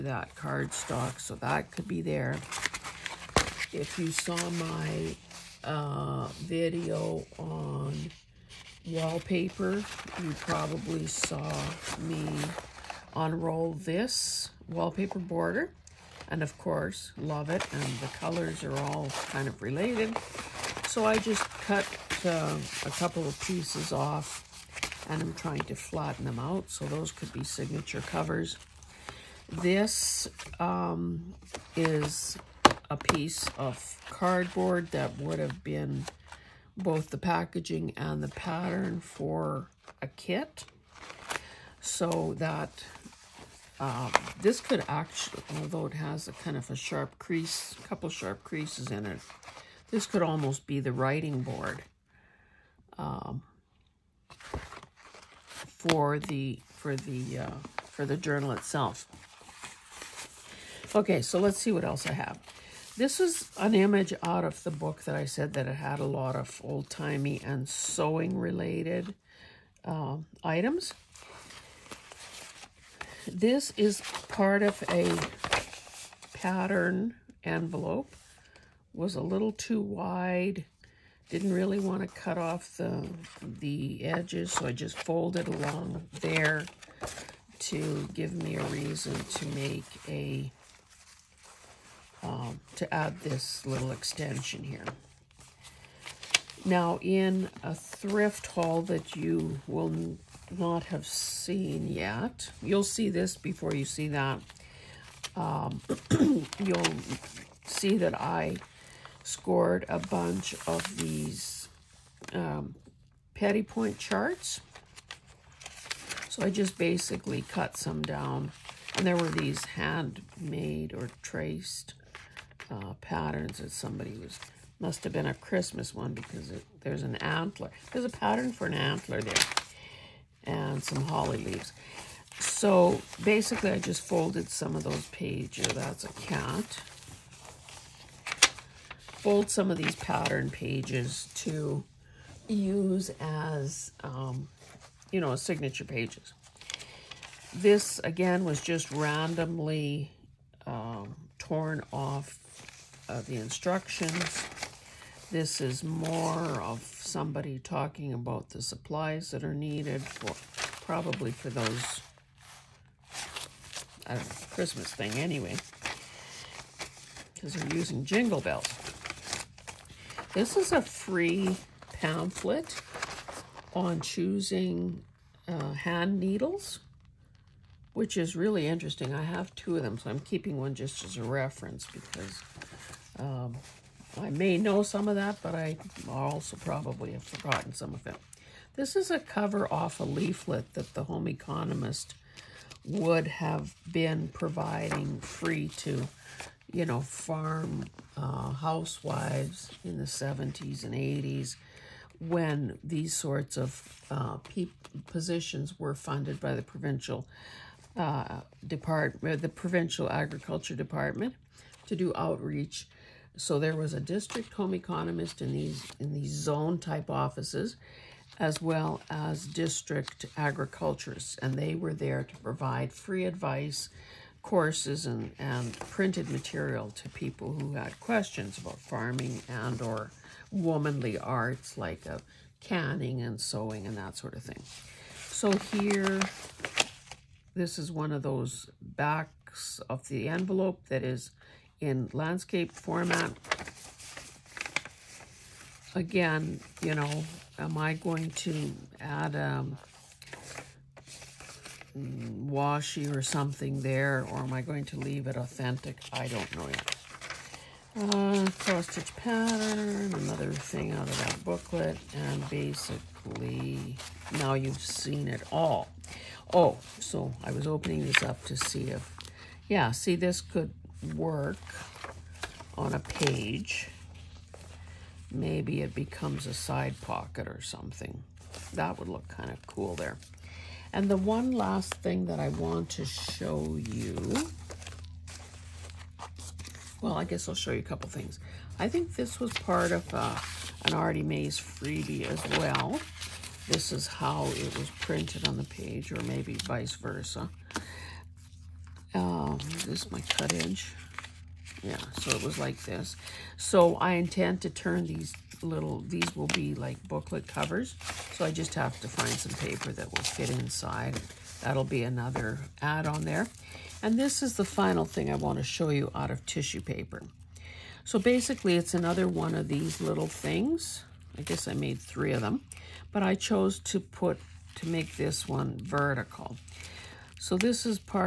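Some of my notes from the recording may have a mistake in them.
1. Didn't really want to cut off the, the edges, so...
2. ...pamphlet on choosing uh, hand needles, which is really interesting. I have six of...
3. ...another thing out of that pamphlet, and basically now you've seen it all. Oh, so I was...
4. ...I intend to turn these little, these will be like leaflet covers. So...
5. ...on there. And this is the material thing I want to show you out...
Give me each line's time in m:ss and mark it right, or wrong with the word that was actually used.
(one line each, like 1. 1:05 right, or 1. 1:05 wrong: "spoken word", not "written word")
1. 1:21 right
2. 2:51 wrong: "two", not "six"
3. 4:20 wrong: "booklet", not "pamphlet"
4. 5:03 wrong: "booklet", not "leaflet"
5. 5:13 wrong: "final", not "material".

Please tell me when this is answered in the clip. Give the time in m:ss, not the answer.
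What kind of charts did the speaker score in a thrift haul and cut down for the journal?
1:53.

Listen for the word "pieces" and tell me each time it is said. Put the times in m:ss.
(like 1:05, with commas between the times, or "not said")
0:23, 0:32.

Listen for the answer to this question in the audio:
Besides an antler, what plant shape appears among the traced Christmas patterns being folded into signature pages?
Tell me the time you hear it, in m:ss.
2:11.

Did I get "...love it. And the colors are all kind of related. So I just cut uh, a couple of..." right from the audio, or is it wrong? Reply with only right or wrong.
right.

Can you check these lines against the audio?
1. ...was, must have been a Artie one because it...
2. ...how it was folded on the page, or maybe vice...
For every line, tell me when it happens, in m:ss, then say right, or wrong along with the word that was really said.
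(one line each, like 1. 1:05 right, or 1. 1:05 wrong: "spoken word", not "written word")
1. 2:04 wrong: "Christmas", not "Artie"
2. 4:54 wrong: "printed", not "folded".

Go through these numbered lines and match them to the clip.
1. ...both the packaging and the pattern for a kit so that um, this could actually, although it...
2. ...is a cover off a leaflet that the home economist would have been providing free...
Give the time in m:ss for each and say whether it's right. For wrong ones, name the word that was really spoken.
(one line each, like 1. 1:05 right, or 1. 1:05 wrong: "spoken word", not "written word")
1. 0:36 right
2. 3:08 right.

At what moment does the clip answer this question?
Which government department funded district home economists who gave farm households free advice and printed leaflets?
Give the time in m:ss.
3:29.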